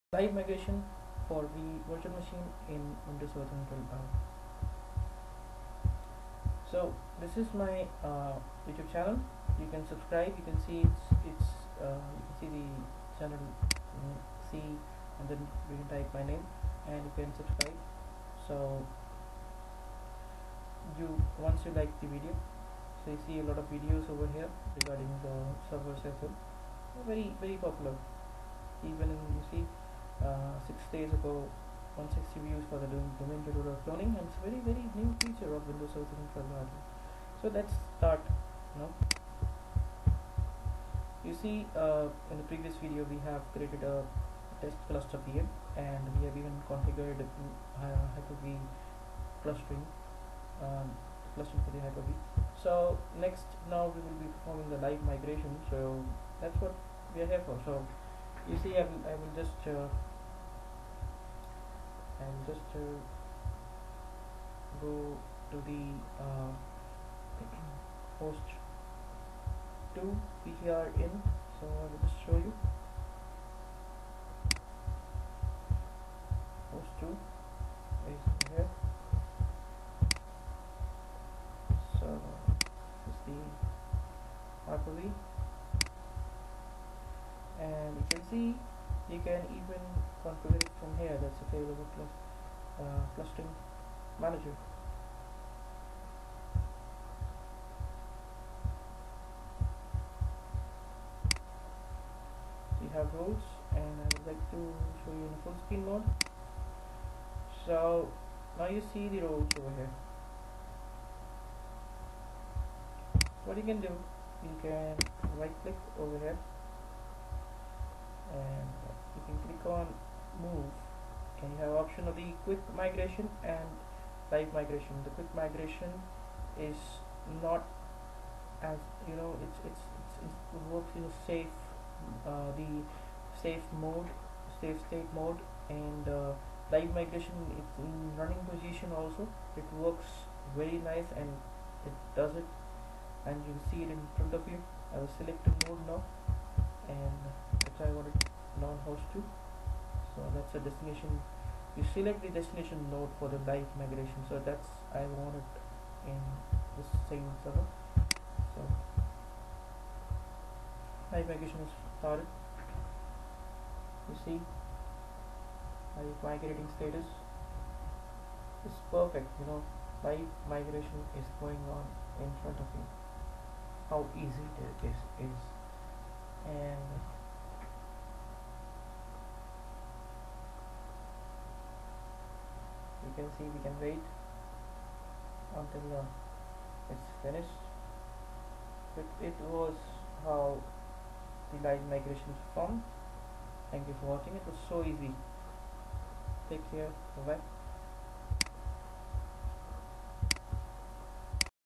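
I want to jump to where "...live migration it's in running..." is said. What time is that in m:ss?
2:16.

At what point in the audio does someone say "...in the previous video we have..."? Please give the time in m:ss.
0:42.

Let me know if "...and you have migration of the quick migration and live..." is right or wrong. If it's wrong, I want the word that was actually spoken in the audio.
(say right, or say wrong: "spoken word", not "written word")
wrong: "option", not "migration".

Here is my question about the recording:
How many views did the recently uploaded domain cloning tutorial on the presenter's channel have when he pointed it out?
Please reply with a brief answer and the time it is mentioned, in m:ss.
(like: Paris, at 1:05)
160, at 0:31.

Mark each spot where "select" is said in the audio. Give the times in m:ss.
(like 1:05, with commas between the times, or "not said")
2:25, 2:31.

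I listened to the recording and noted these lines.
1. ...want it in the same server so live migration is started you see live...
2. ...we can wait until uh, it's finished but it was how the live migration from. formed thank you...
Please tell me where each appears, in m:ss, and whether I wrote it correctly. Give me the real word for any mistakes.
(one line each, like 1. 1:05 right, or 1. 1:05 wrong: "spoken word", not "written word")
1. 2:35 right
2. 3:03 right.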